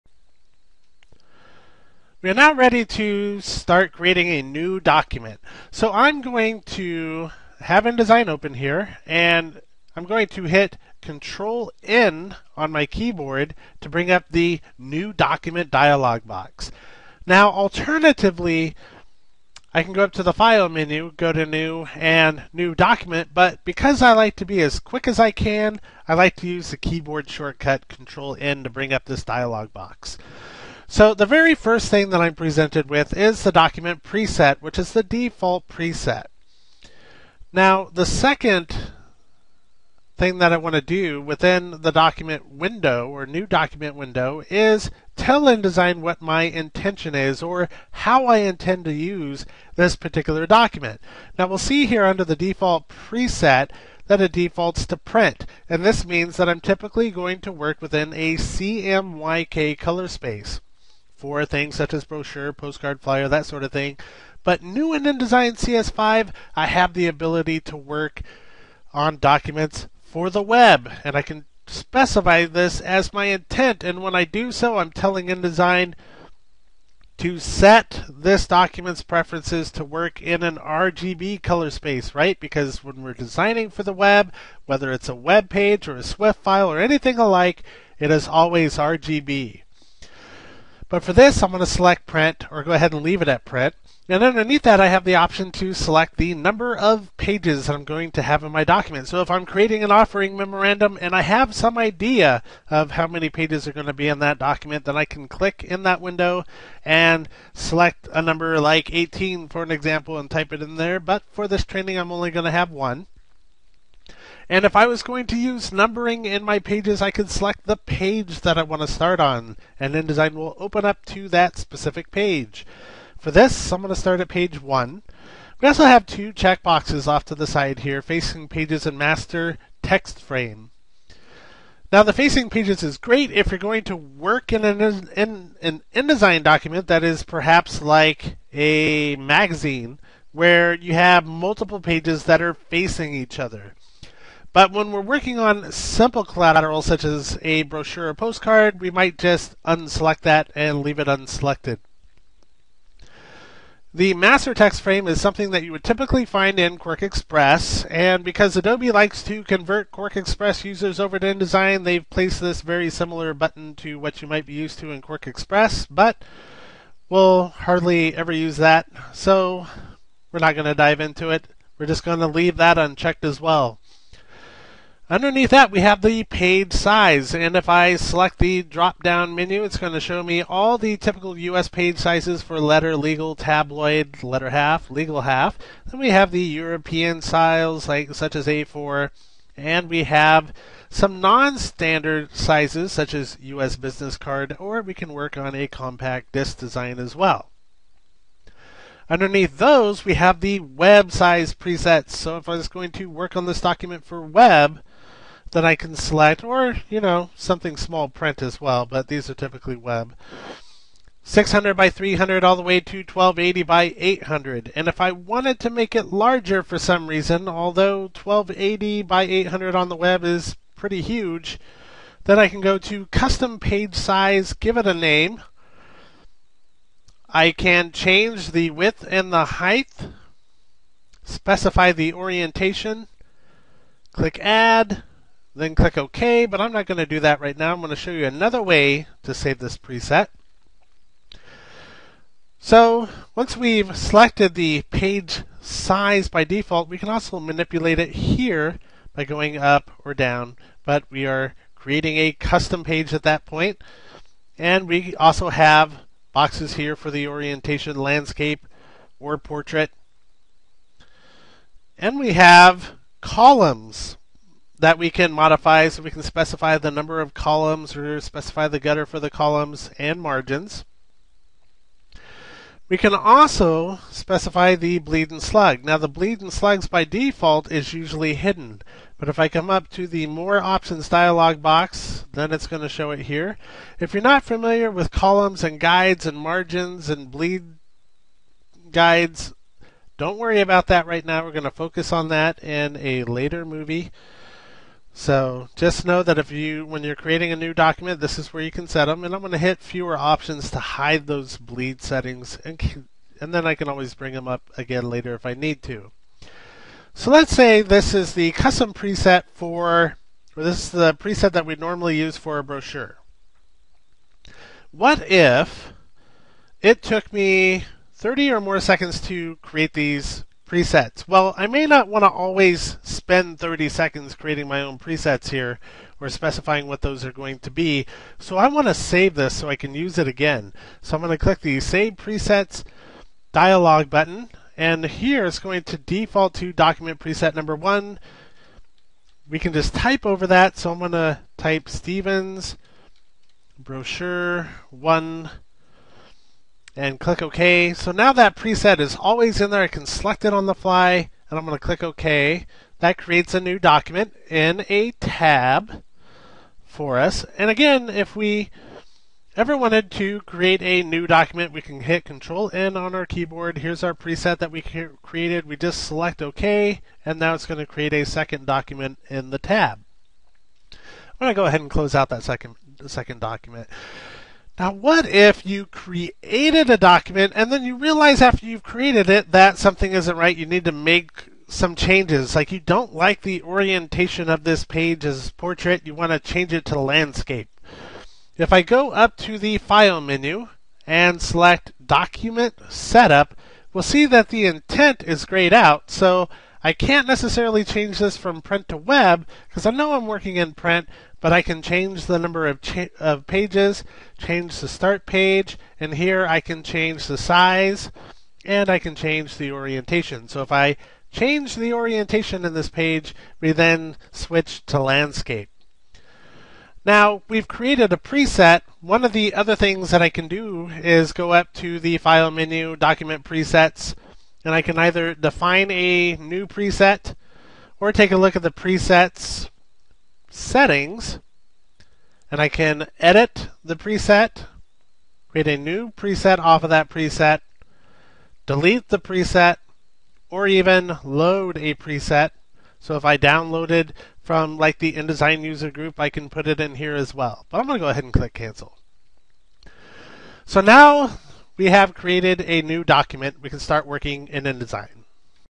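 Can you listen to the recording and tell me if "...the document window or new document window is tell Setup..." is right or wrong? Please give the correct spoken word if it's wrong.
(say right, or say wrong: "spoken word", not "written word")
wrong: "InDesign", not "Setup".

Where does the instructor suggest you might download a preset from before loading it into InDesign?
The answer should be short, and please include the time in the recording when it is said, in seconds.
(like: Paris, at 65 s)
InDesign user group, at 445 s.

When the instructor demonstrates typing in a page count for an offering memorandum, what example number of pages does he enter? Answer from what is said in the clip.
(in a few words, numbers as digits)
18.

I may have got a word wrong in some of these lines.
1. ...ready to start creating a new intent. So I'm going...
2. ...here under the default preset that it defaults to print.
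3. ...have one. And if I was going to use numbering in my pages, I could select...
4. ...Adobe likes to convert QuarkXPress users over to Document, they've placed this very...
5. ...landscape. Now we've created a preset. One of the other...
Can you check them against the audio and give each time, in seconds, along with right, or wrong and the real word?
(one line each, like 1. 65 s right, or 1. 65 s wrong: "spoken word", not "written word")
1. 2 s wrong: "document", not "intent"
2. 51 s right
3. 112 s right
4. 158 s wrong: "InDesign", not "Document"
5. 414 s right.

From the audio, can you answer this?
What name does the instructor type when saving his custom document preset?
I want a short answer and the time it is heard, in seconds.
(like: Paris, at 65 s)
Stevens brochure one, at 341 s.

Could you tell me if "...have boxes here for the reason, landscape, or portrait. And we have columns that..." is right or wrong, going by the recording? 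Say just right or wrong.
wrong.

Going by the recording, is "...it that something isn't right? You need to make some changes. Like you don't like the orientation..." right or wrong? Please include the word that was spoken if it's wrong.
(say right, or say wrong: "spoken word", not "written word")
right.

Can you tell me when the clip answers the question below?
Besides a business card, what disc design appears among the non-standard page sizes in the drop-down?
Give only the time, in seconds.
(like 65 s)
195 s.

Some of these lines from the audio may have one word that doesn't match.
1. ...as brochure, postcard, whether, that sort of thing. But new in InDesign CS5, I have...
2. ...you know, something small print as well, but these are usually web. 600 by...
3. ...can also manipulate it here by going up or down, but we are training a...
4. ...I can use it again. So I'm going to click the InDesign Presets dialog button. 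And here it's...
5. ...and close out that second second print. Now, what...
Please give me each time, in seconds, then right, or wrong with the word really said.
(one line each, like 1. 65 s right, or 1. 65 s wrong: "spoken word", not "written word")
1. 61 s wrong: "flyer", not "whether"
2. 206 s wrong: "typically", not "usually"
3. 246 s wrong: "creating", not "training"
4. 329 s wrong: "Save", not "InDesign"
5. 371 s wrong: "document", not "print".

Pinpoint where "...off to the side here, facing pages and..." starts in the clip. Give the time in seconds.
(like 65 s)
127 s.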